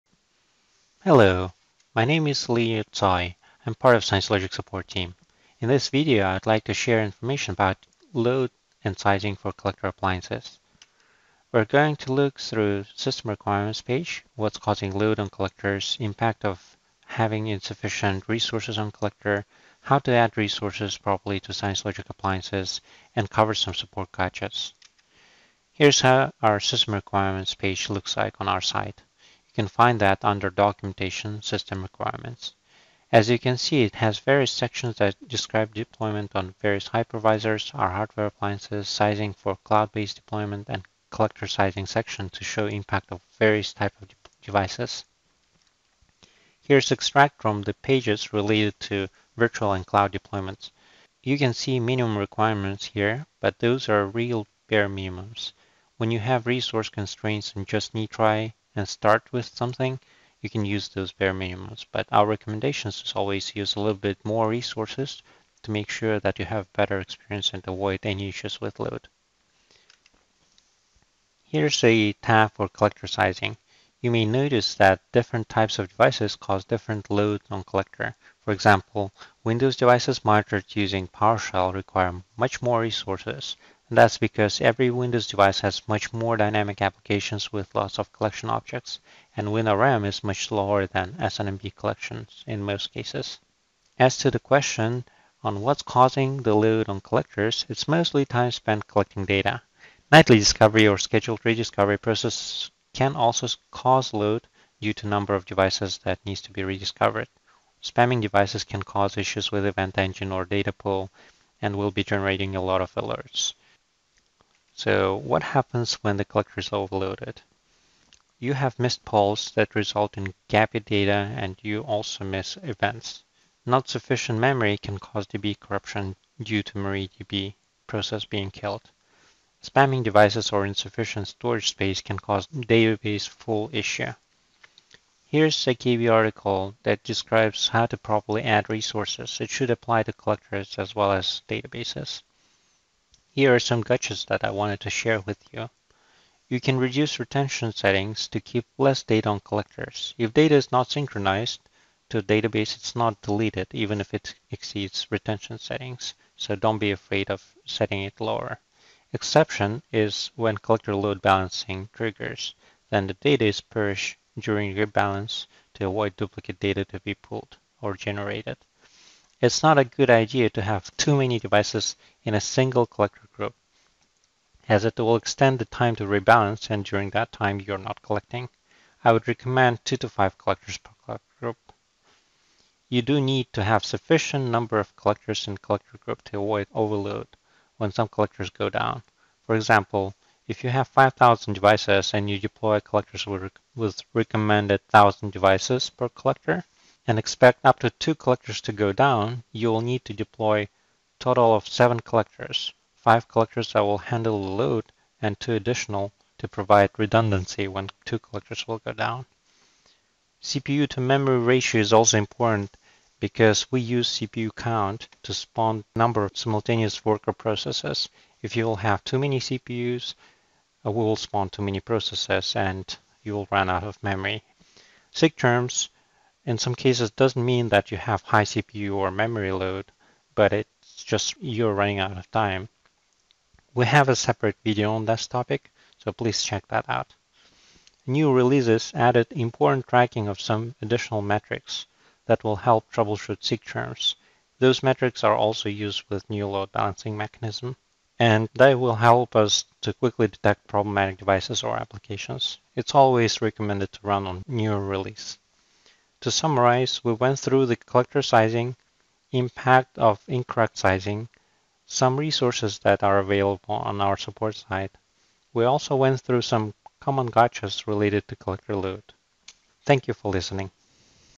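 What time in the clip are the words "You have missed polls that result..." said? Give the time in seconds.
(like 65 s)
118 s.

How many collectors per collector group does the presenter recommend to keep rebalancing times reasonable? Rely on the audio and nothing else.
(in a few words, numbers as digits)
2 to 5.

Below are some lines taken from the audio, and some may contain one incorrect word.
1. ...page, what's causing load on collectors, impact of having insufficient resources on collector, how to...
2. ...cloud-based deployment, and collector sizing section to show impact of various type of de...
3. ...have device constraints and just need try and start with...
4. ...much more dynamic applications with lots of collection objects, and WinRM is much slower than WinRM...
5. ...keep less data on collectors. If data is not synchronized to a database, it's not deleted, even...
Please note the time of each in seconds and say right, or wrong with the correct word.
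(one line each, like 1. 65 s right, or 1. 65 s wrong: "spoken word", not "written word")
1. 13 s right
2. 39 s right
3. 56 s wrong: "resource", not "device"
4. 85 s wrong: "SNMP", not "WinRM"
5. 148 s right.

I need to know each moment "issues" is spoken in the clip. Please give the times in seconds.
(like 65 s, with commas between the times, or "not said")
68 s, 109 s, 133 s.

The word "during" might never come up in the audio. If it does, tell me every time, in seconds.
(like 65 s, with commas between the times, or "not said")
164 s, 176 s.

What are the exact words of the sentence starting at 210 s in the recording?
CPU to memory ratio is also important because we use CPU count to spawn number of simultaneous worker processes.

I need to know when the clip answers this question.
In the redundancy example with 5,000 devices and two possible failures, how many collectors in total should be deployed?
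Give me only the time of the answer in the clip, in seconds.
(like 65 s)
201 s.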